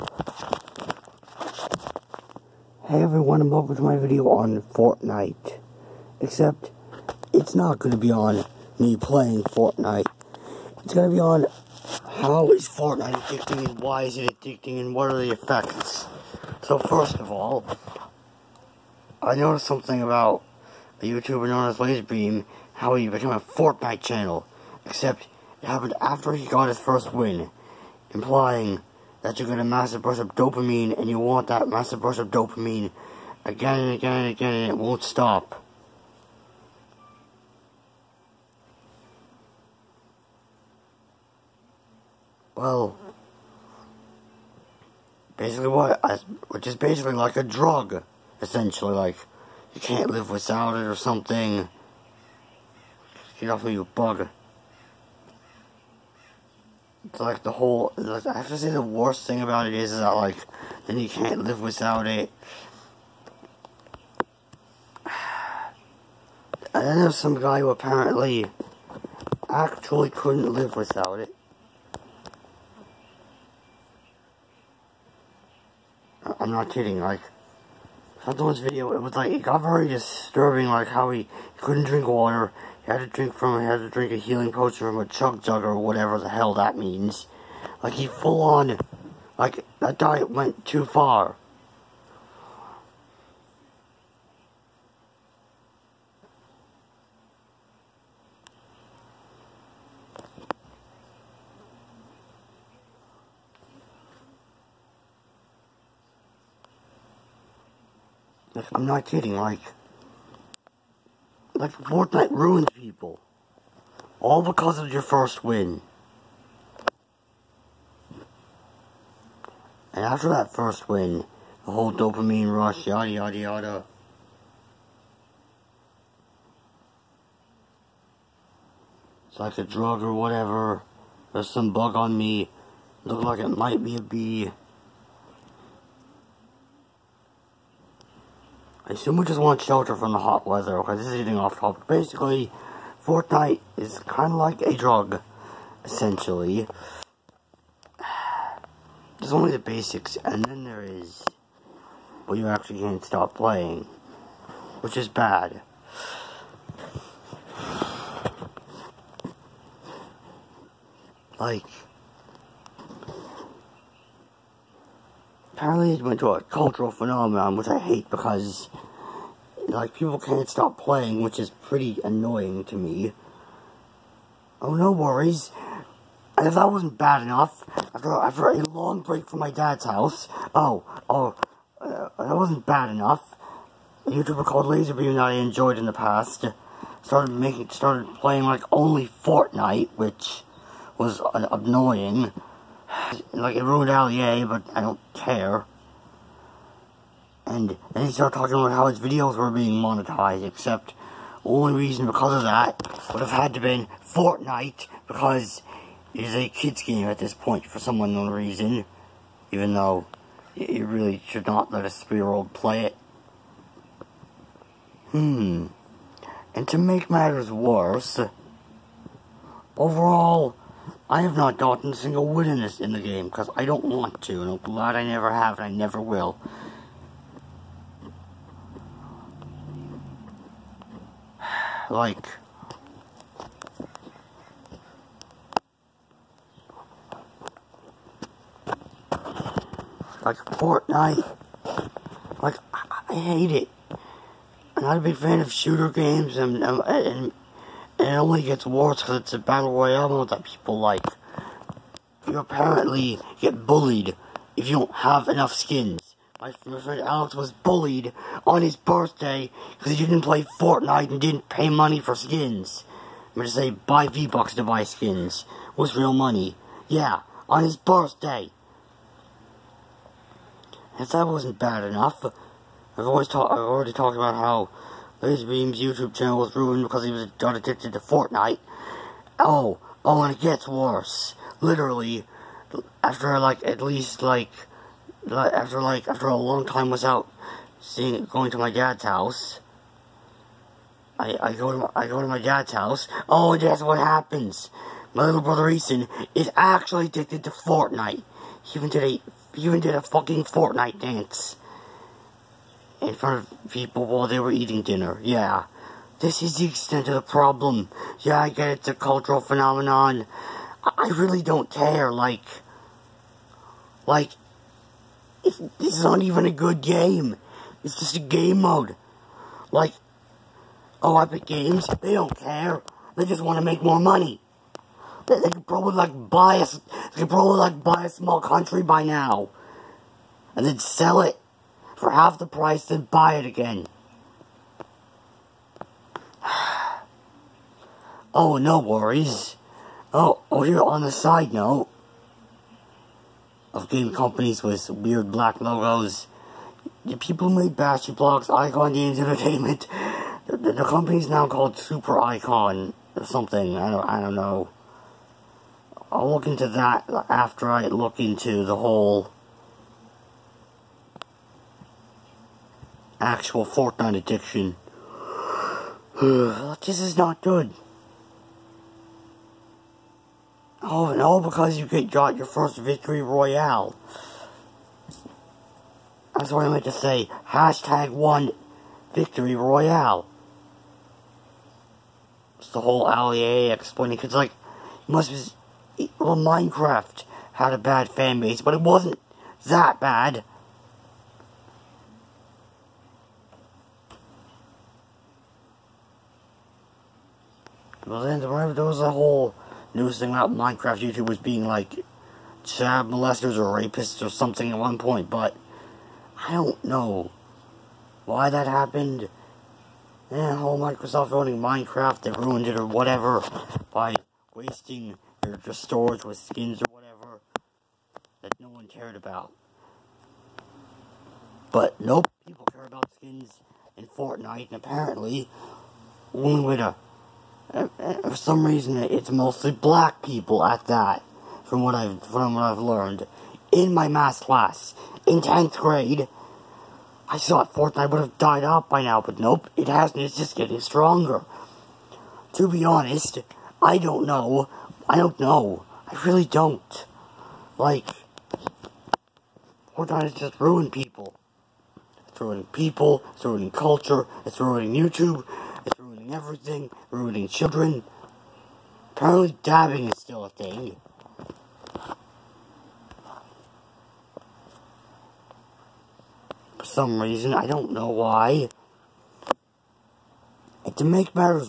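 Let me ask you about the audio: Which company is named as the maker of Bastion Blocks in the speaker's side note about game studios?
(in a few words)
Icon Games Entertainment.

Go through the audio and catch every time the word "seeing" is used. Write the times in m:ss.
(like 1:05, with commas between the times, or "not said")
4:47.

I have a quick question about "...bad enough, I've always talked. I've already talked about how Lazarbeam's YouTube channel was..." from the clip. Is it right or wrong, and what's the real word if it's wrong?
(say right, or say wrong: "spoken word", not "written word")
right.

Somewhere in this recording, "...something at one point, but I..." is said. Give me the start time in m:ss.
6:44.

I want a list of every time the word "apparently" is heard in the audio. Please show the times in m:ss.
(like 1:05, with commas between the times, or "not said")
1:07, 2:45, 4:12, 7:04, 7:39.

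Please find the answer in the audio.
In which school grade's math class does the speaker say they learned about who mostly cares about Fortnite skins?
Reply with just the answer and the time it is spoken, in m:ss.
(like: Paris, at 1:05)
10th grade, at 7:15.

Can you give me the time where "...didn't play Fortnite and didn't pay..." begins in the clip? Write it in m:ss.
4:20.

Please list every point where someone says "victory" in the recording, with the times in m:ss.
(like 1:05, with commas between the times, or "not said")
6:12, 6:19.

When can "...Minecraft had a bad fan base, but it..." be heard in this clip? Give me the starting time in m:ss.
6:26.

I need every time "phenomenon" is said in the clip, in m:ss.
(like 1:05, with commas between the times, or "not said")
2:46, 5:09.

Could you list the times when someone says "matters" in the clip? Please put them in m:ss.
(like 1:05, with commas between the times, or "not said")
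3:37.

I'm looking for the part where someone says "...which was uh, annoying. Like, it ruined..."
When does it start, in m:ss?
3:09.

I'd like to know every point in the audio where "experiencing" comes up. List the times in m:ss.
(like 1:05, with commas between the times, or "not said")
not said.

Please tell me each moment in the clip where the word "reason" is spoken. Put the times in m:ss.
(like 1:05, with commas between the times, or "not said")
3:21, 3:28, 7:08, 7:47.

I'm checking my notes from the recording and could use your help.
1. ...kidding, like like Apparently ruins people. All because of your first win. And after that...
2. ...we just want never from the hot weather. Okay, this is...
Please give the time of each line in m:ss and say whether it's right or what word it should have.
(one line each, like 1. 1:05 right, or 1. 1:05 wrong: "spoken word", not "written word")
1. 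1:49 wrong: "Fortnite", not "Apparently"
2. 2:19 wrong: "shelter", not "never".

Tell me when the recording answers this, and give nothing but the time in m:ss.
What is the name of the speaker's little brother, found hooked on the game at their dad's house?
4:55.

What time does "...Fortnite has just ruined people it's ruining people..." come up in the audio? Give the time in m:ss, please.
7:29.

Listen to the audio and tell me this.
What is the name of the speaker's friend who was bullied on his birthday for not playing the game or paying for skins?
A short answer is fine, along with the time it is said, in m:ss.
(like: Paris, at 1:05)
Alex, at 4:16.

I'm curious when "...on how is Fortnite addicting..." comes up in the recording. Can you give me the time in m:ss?
0:11.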